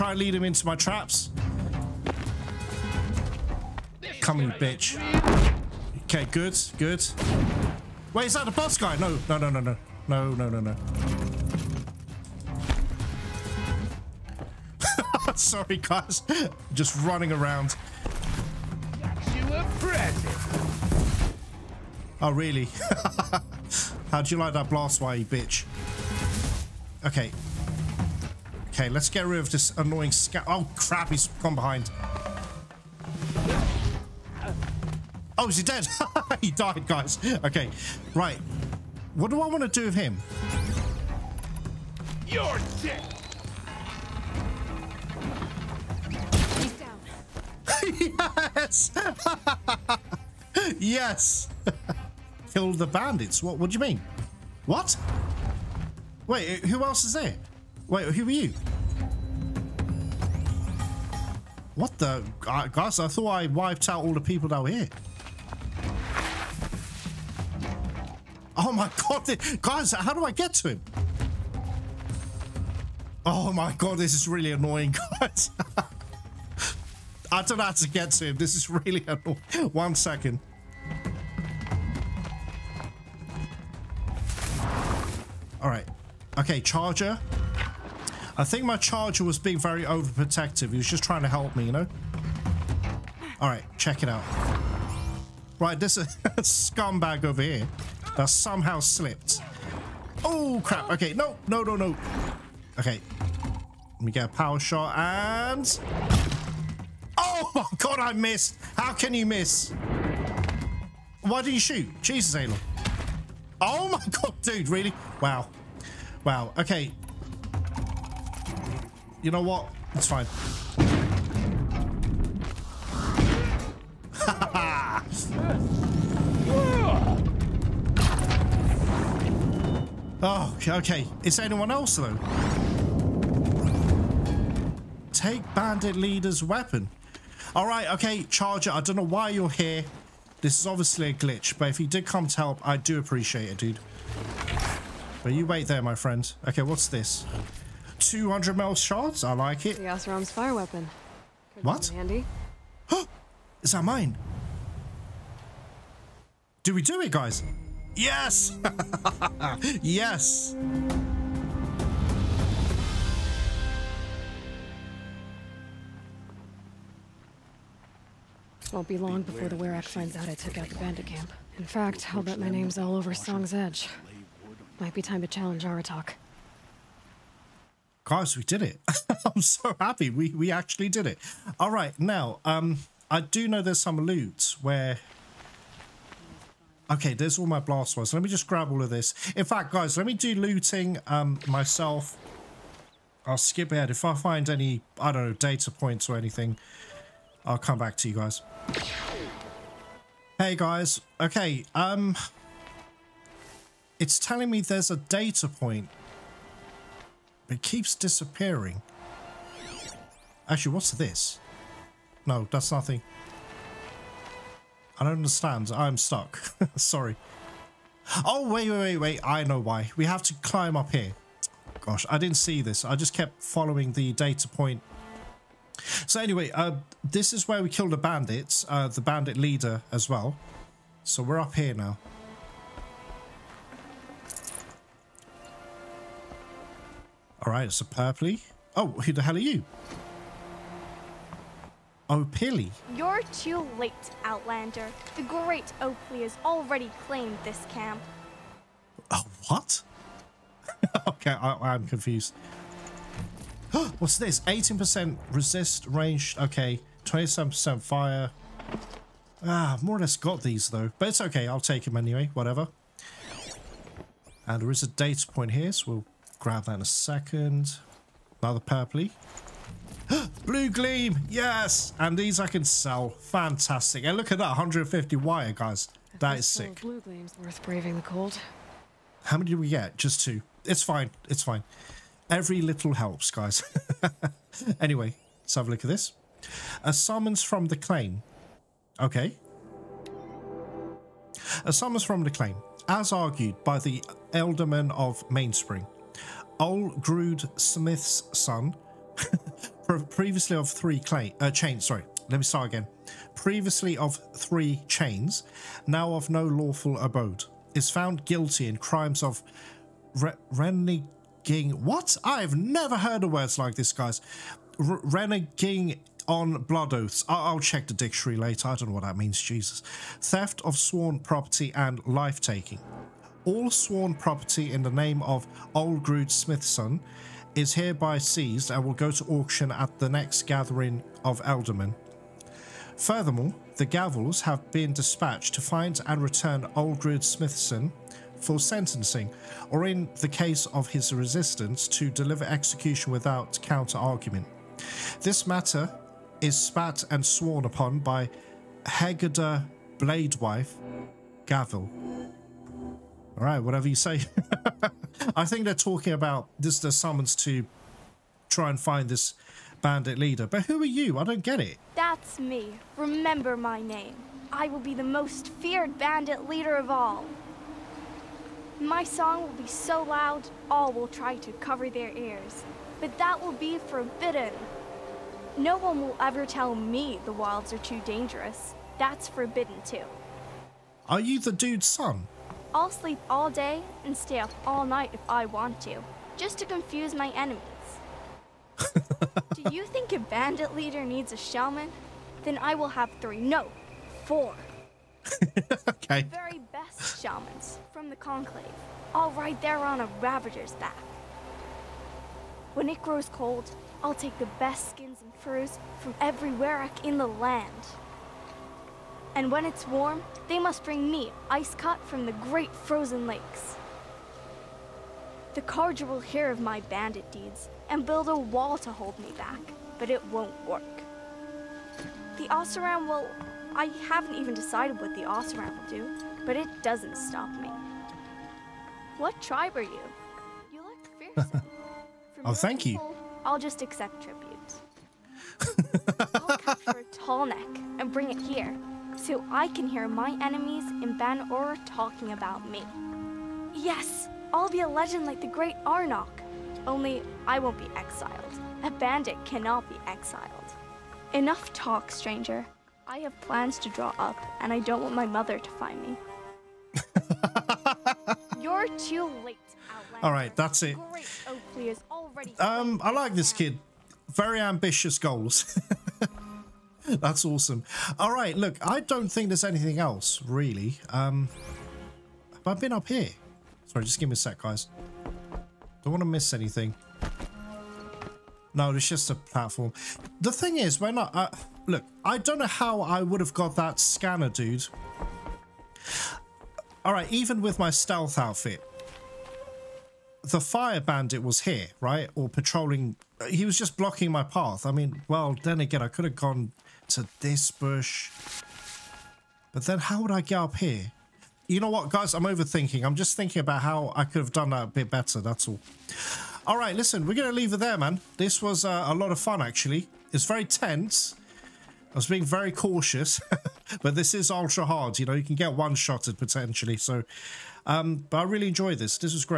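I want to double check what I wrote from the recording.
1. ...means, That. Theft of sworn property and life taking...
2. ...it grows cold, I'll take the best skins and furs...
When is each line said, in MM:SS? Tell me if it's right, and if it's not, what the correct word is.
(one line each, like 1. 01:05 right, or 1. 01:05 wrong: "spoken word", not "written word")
1. 05:19 wrong: "Jesus", not "That"
2. 06:42 right.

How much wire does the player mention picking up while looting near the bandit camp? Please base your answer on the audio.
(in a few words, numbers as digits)
150.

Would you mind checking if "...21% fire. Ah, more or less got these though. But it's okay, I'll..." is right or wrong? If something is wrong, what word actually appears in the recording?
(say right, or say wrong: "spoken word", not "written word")
wrong: "27", not "21".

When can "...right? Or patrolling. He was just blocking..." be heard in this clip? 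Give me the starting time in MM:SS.
08:11.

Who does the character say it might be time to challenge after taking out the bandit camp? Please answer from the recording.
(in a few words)
Aratak.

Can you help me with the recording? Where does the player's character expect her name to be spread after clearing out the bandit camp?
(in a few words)
Song's Edge.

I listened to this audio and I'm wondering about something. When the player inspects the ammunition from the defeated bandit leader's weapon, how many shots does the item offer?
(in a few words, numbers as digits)
200.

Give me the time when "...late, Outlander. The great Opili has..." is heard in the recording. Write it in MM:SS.
04:03.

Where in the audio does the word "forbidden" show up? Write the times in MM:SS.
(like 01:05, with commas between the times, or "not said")
06:13, 06:19.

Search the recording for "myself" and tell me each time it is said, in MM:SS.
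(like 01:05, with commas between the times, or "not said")
03:11.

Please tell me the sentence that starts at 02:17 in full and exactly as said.
All right, okay, Charger, I don't know why you're here.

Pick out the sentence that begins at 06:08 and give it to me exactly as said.
My song will be so loud, all will try to cover their ears.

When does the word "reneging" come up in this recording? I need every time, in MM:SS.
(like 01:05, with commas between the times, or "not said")
05:10, 05:14.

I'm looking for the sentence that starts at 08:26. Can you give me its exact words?
All right, listen, we're going to leave it there, man.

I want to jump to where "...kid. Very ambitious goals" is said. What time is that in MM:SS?
07:43.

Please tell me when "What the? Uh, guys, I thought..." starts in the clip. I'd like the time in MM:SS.
01:01.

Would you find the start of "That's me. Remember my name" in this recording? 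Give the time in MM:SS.
06:01.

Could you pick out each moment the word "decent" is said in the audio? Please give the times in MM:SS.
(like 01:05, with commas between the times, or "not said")
not said.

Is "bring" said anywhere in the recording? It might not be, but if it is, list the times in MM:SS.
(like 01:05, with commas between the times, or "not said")
06:50, 07:18.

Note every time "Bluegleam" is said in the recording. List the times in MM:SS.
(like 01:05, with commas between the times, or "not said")
04:30, 04:36.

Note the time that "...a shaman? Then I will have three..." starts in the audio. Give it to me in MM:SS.
06:31.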